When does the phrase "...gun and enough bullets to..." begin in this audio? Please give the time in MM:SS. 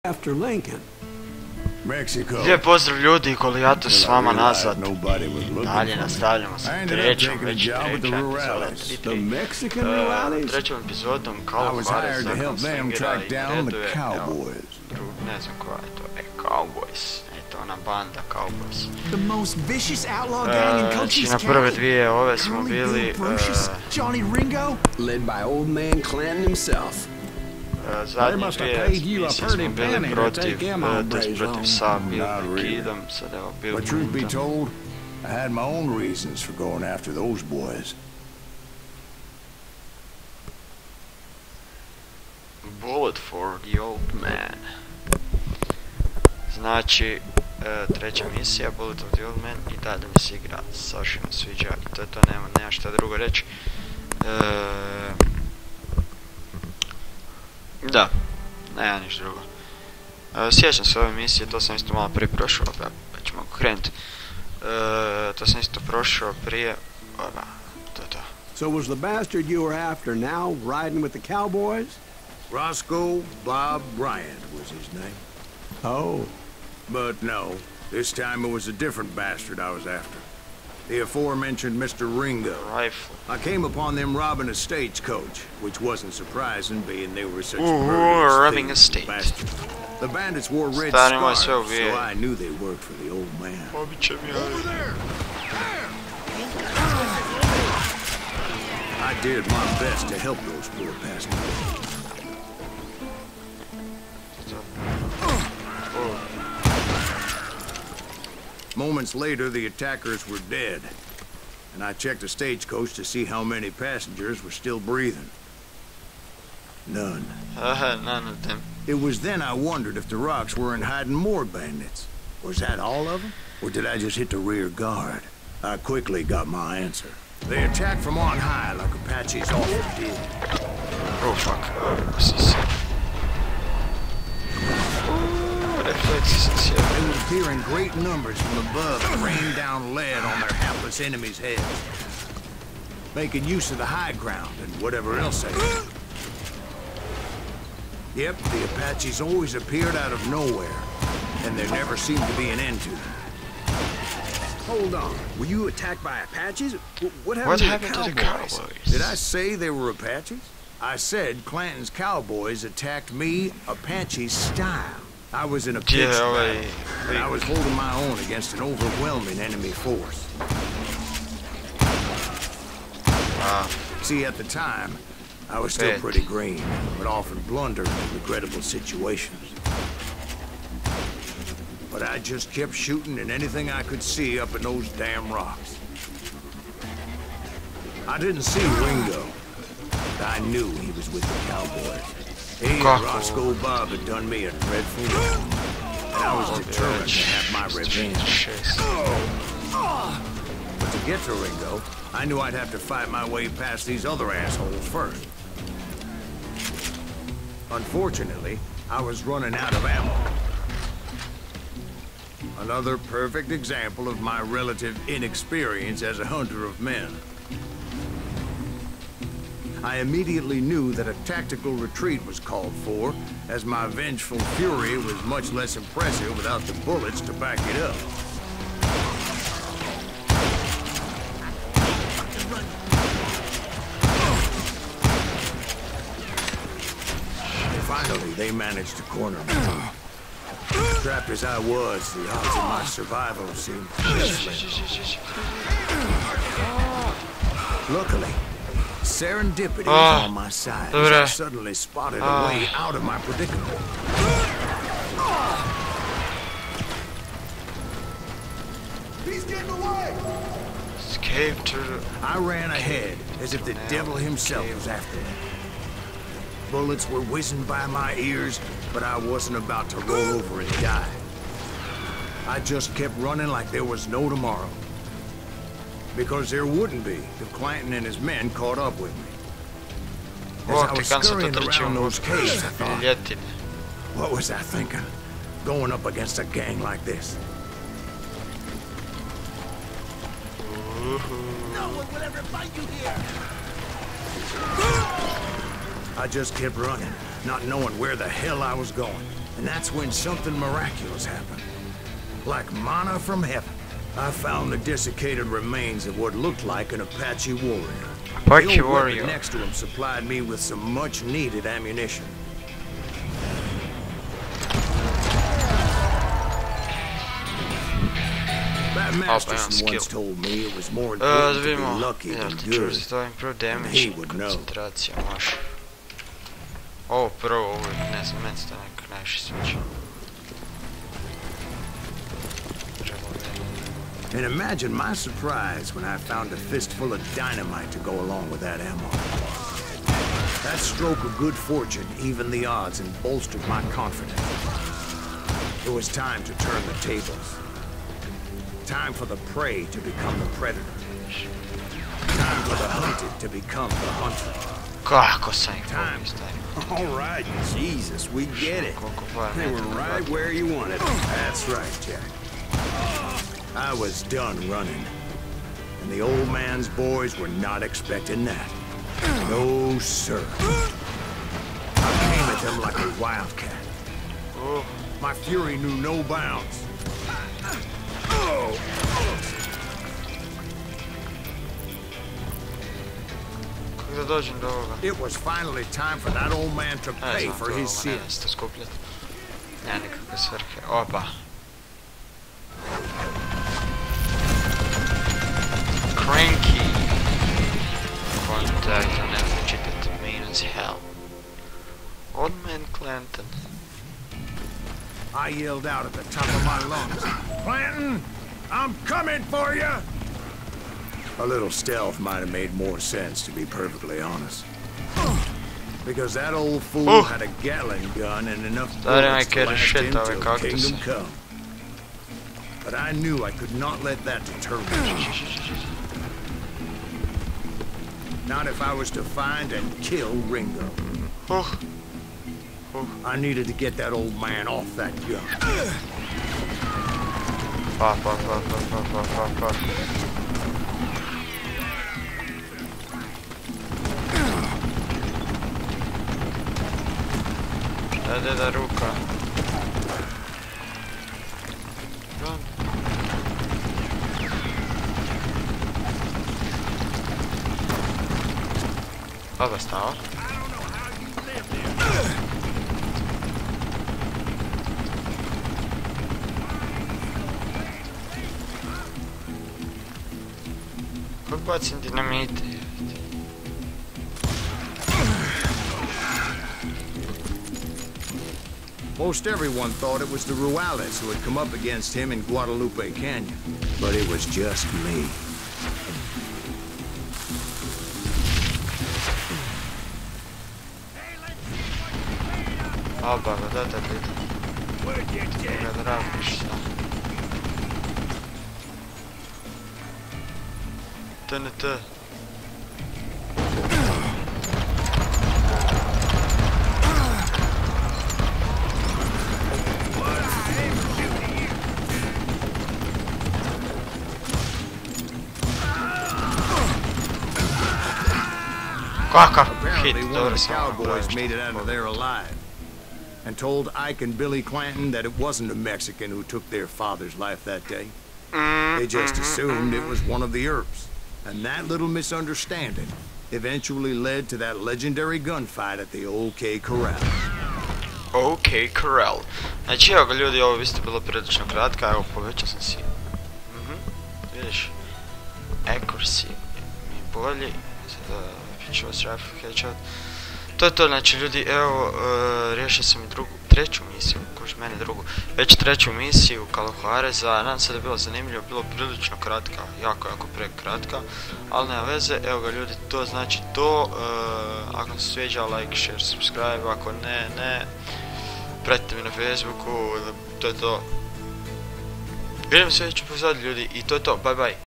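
06:58.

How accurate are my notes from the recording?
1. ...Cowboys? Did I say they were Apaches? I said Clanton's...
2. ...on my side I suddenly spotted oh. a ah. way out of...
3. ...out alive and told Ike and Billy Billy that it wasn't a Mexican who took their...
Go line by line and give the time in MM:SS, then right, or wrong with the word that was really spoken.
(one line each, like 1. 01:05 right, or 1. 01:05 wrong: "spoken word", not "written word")
1. 02:38 right
2. 04:10 right
3. 08:41 wrong: "Clanton", not "Billy".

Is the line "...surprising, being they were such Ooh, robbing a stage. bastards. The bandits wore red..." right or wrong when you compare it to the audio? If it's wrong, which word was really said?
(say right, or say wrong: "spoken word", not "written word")
right.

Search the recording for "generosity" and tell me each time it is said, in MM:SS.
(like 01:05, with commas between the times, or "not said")
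not said.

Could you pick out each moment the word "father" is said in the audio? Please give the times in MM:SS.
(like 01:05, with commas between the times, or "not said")
08:46.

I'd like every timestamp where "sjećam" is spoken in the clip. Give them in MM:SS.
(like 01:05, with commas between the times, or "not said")
01:00.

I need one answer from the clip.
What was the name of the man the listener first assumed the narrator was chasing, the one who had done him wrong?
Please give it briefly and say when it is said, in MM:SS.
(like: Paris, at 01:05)
Roscoe Bob Bryant, at 01:12.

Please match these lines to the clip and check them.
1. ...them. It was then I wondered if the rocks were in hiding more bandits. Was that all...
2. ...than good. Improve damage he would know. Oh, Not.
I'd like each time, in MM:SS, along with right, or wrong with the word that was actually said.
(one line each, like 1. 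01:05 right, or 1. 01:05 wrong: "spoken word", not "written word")
1. 01:58 right
2. 05:22 wrong: "Маша", not "Not".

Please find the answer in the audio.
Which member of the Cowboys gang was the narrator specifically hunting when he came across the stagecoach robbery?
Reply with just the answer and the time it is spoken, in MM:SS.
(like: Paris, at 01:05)
Johnny Ringo, at 01:21.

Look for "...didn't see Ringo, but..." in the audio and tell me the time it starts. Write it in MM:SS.
03:08.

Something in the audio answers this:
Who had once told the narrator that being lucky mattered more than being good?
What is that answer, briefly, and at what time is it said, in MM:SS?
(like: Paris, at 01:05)
Masterson, at 05:19.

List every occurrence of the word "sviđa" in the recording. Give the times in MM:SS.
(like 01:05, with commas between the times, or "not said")
00:51, 09:25.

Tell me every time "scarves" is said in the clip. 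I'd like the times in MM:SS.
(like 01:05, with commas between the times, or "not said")
01:31.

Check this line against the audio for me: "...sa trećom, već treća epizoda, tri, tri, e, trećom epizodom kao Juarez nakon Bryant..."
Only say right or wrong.
wrong.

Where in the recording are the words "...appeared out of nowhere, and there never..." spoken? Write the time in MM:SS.
02:29.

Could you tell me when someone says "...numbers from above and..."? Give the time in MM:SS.
02:17.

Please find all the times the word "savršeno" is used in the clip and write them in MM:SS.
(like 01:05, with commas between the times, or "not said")
00:50.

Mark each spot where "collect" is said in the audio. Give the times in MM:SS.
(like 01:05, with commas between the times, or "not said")
not said.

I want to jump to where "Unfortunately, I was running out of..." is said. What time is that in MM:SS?
03:27.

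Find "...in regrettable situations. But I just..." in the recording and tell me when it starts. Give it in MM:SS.
02:57.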